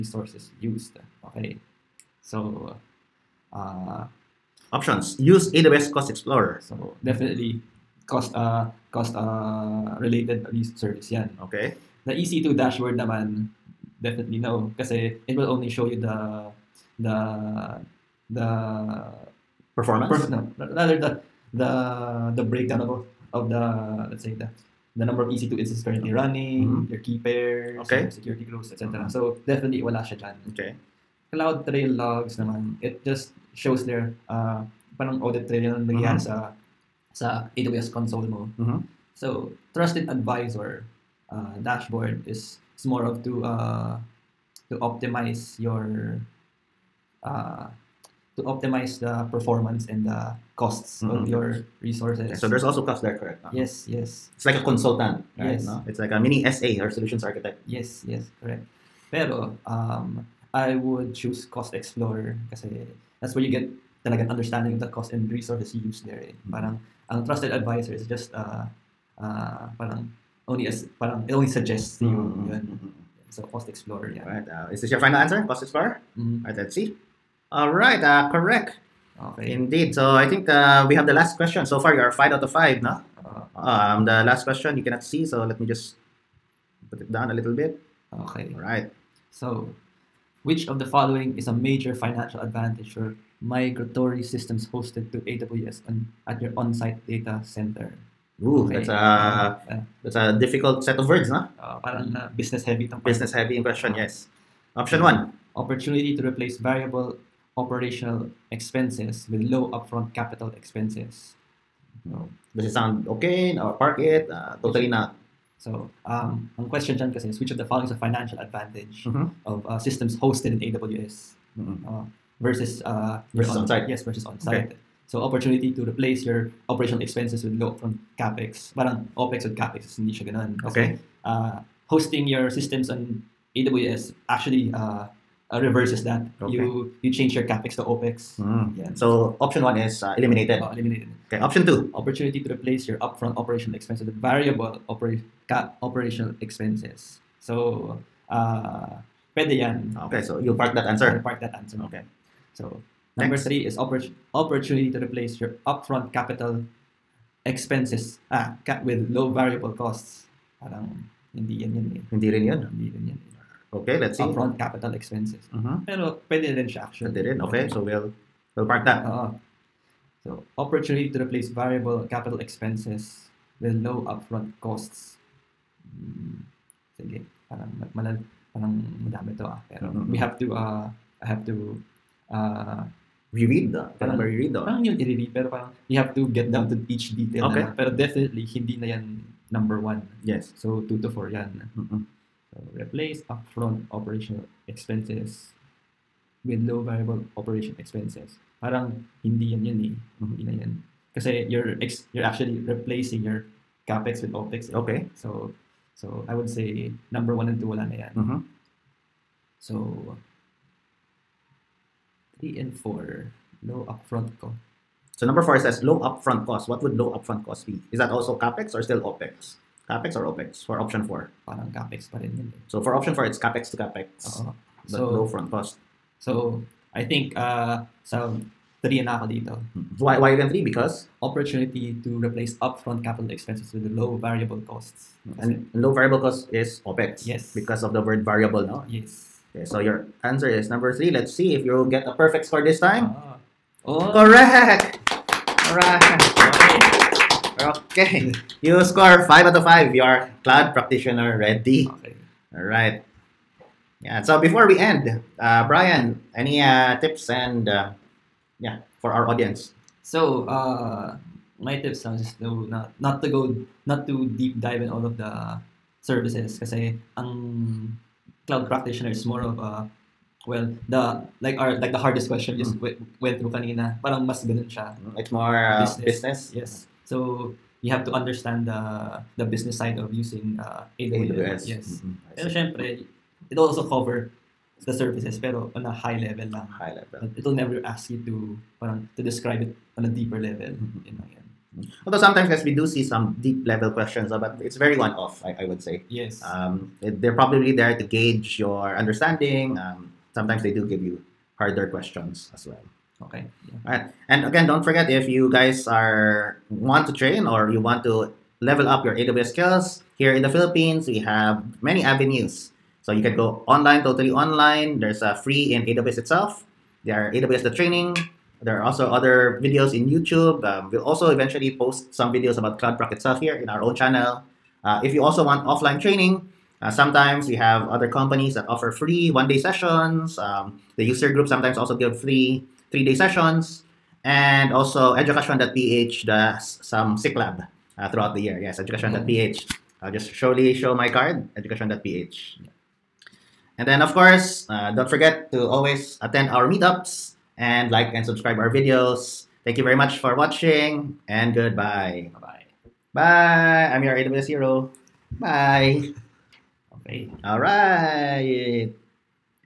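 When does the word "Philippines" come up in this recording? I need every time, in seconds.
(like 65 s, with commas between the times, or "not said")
310 s.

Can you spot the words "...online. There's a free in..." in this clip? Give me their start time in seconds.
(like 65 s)
314 s.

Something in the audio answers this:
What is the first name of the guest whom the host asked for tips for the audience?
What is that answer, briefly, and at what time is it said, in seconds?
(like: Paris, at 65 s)
Brian, at 255 s.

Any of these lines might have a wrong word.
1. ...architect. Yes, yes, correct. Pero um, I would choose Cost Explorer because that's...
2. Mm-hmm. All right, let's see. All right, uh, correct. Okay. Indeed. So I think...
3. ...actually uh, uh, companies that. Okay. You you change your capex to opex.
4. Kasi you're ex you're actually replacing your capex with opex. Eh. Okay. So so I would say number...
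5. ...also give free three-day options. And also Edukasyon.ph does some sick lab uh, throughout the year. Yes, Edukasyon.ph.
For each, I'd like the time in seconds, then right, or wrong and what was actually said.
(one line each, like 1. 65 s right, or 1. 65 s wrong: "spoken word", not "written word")
1. 57 s right
2. 76 s right
3. 134 s wrong: "reverses", not "companies"
4. 201 s right
5. 331 s wrong: "sessions", not "options".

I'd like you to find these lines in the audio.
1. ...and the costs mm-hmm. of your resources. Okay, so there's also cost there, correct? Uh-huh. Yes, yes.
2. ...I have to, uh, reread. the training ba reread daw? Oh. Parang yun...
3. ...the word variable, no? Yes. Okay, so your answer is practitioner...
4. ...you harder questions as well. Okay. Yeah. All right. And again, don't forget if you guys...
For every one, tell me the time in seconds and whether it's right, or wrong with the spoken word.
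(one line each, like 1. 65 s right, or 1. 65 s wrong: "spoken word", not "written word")
1. 49 s right
2. 181 s wrong: "parang", not "training"
3. 237 s wrong: "number", not "practitioner"
4. 301 s right.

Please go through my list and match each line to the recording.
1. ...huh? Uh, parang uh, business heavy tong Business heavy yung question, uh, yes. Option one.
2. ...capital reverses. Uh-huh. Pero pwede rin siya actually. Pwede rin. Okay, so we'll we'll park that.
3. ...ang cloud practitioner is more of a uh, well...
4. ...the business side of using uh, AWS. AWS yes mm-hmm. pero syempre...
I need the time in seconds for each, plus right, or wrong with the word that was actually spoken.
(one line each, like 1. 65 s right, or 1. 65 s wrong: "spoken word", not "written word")
1. 101 s right
2. 164 s wrong: "expenses", not "reverses"
3. 267 s right
4. 279 s right.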